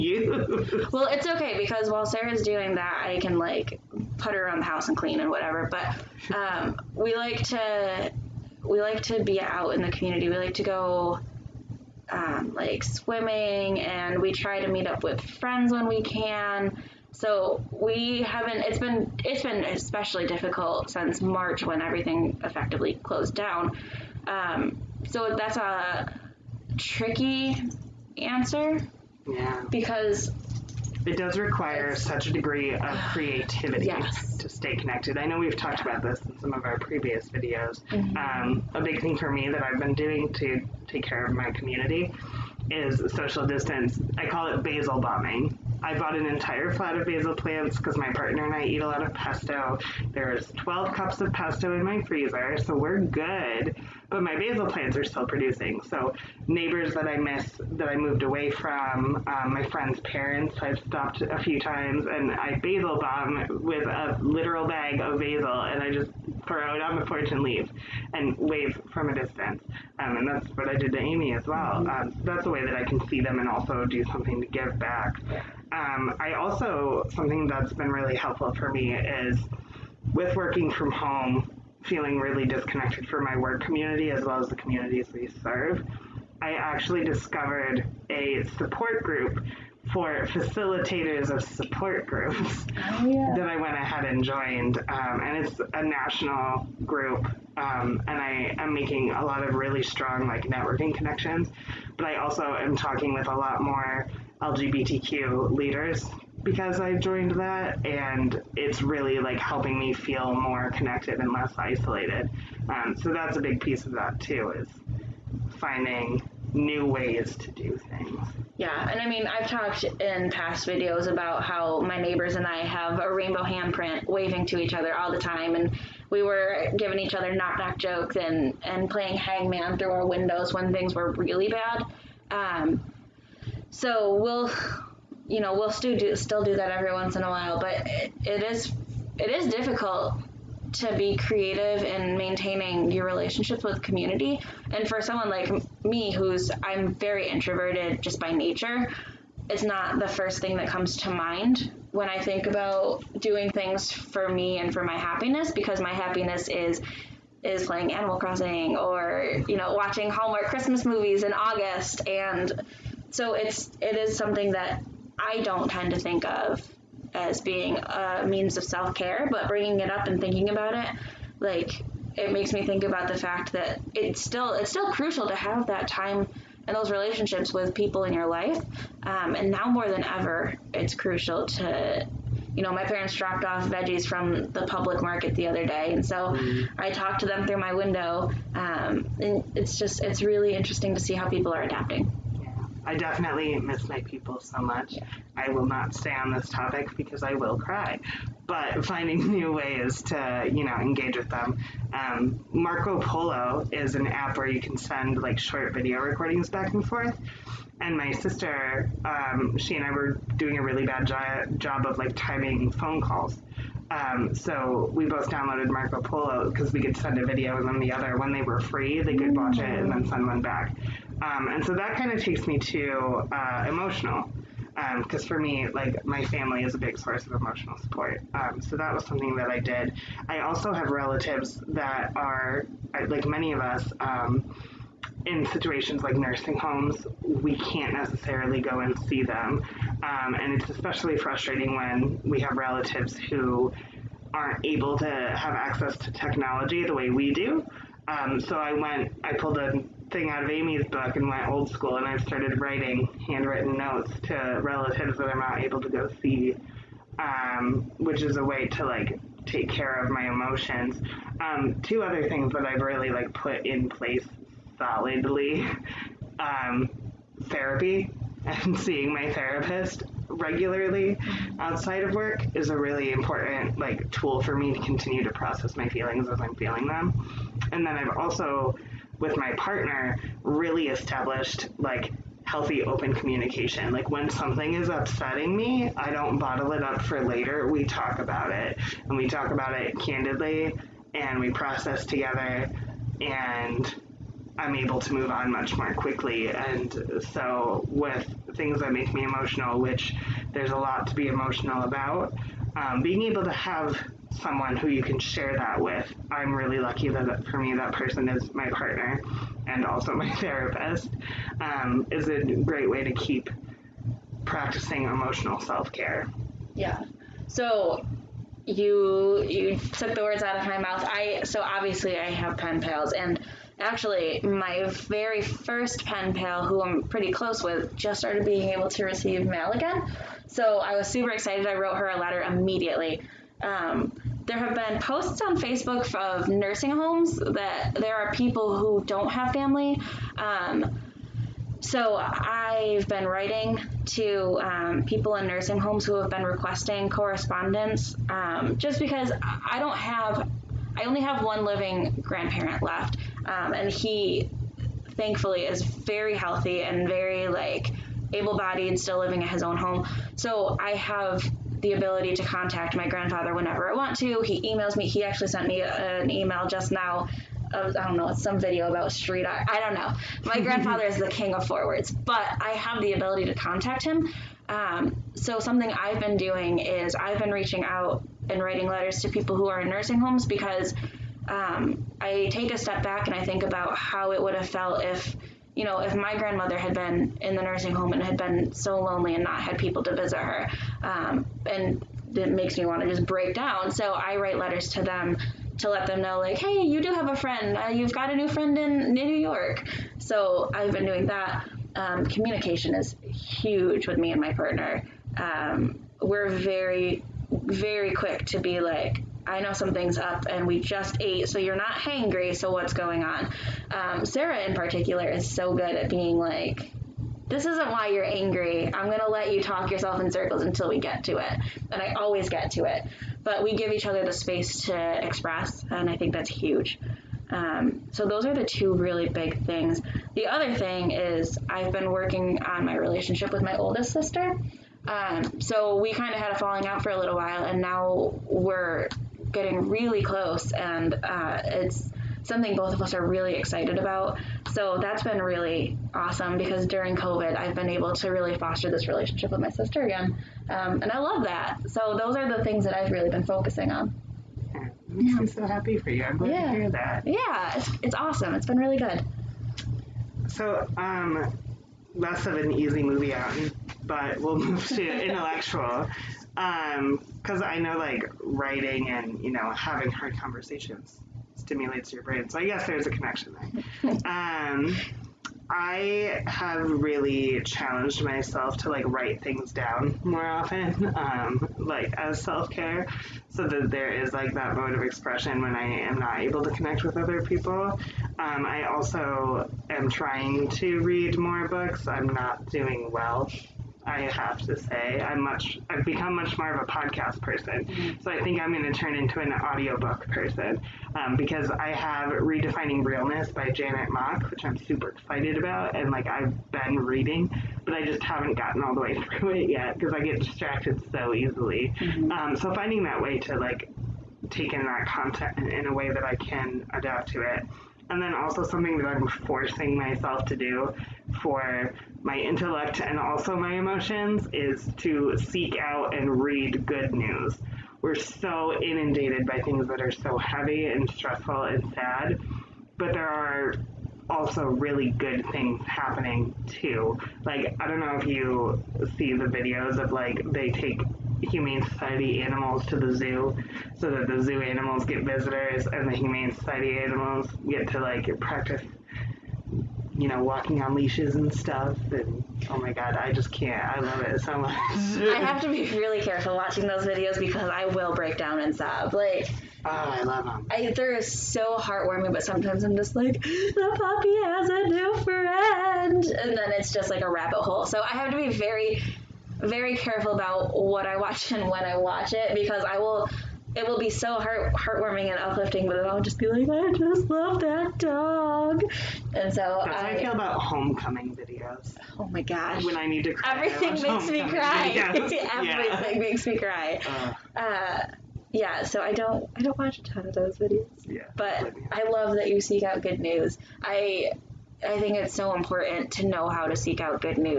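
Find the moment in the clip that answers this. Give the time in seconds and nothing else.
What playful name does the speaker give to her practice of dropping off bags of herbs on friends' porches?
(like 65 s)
44 s.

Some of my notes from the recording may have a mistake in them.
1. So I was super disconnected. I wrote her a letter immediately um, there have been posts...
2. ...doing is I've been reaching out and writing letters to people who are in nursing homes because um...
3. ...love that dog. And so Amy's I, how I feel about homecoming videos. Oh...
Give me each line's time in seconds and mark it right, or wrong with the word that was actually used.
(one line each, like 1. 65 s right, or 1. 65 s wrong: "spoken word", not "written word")
1. 330 s wrong: "excited", not "disconnected"
2. 376 s right
3. 577 s wrong: "That", not "Amy".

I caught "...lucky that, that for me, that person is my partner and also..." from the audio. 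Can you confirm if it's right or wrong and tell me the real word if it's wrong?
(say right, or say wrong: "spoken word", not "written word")
right.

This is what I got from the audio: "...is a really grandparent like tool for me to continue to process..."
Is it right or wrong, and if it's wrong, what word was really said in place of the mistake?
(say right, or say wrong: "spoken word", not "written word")
wrong: "important", not "grandparent".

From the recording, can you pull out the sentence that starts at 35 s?
about this in some of our previous videos.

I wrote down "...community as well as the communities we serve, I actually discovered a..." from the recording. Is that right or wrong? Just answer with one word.
right.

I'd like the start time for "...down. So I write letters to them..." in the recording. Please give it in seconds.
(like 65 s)
393 s.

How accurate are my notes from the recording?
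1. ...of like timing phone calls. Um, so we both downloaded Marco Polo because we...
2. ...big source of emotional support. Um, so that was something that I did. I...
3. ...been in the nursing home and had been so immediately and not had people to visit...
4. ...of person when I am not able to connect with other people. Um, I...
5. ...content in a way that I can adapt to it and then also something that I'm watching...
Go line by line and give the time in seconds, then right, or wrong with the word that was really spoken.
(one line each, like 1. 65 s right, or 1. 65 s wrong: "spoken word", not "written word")
1. 211 s right
2. 226 s right
3. 386 s wrong: "lonely", not "immediately"
4. 484 s wrong: "expression", not "person"
5. 515 s wrong: "forcing", not "watching".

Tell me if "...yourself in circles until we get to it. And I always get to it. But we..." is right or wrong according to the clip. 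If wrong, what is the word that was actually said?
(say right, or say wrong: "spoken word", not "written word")
right.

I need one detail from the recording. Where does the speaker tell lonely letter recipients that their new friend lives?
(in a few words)
New York.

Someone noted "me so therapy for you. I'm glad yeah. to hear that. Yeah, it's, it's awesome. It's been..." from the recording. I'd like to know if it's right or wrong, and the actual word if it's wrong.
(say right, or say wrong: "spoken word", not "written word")
wrong: "happy", not "therapy".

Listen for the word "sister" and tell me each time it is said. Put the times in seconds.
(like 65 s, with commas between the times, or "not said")
208 s, 434 s, 449 s.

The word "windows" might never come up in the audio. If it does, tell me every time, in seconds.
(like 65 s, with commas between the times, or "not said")
130 s, 187 s.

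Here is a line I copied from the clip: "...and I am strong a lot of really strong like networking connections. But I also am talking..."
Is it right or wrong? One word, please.
wrong.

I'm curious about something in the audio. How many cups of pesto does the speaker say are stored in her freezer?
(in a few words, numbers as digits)
12.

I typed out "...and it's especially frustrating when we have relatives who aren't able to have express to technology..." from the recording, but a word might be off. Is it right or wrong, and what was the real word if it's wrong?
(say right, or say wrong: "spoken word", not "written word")
wrong: "access", not "express".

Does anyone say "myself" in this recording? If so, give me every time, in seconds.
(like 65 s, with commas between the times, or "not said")
478 s, 519 s.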